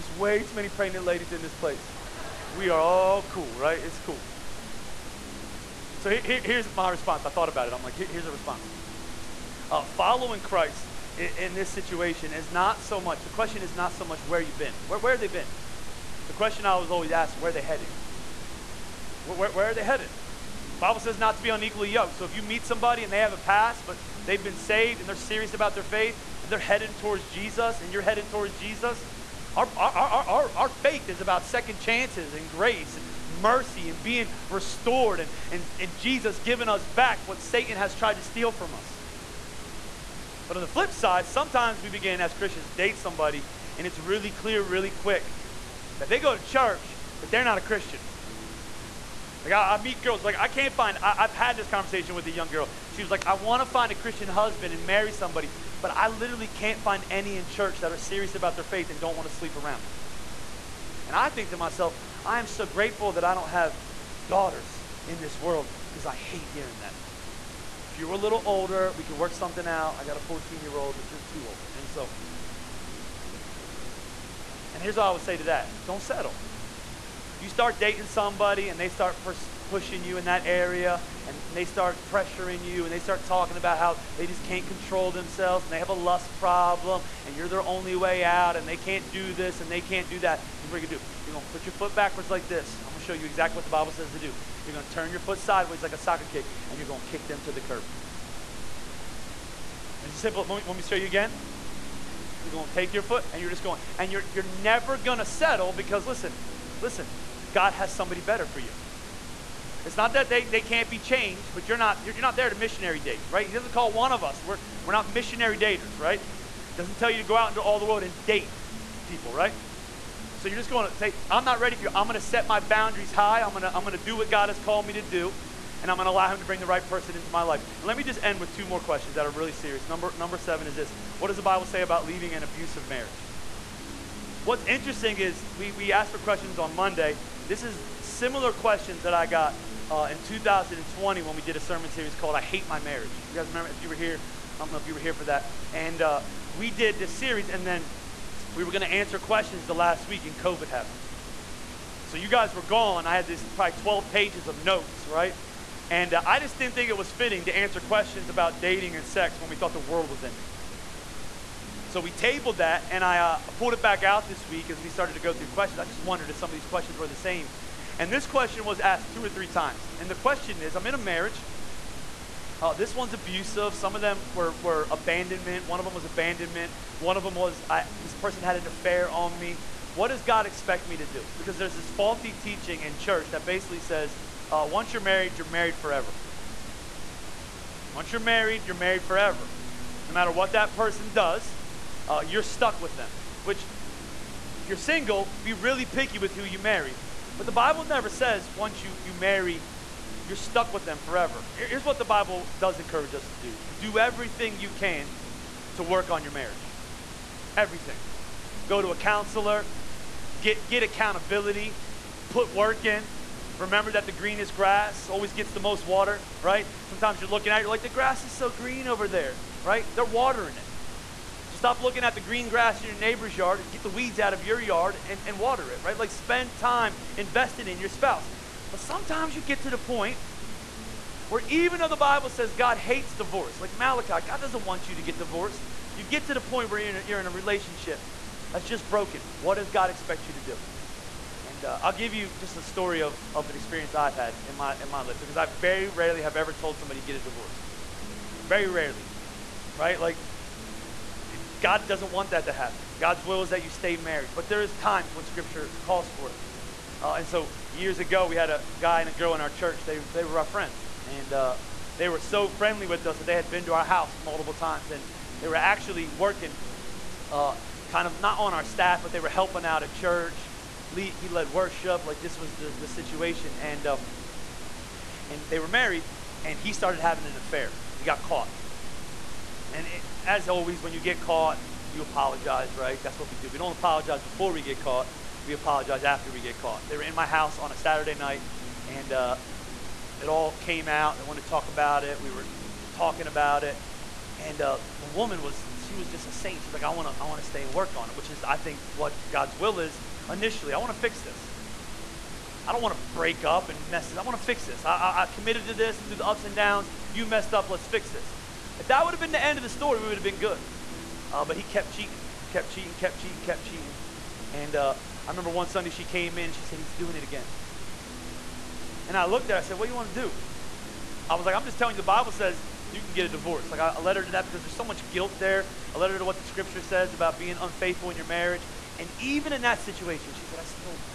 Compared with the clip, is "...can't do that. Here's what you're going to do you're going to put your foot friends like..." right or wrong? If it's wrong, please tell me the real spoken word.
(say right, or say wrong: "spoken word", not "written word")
wrong: "backwards", not "friends".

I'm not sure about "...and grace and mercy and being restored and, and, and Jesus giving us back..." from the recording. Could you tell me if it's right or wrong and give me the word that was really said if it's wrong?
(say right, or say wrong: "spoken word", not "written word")
right.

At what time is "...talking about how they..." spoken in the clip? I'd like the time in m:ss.
1:23.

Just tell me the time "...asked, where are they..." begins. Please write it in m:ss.
0:17.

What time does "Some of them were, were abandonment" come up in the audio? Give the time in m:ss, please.
2:53.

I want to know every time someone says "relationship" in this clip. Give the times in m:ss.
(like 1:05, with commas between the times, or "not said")
3:57.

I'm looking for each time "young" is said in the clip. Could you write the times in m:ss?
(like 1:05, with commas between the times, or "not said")
0:52.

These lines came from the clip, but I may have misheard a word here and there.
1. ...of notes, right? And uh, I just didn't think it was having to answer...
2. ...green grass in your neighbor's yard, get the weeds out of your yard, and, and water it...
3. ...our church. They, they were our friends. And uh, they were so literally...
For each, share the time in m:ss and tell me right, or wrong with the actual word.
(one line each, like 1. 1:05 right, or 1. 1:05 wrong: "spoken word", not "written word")
1. 2:34 wrong: "fitting", not "having"
2. 3:42 right
3. 4:19 wrong: "friendly", not "literally".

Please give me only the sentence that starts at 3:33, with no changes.
Remember that the greenest grass always gets the most water, right?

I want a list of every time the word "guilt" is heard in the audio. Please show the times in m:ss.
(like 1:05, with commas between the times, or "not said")
5:25.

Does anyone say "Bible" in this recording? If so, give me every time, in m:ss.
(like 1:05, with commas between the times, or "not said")
0:20, 1:33, 2:11, 3:17, 3:22, 3:51, 5:22.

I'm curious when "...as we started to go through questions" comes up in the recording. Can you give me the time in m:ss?
2:44.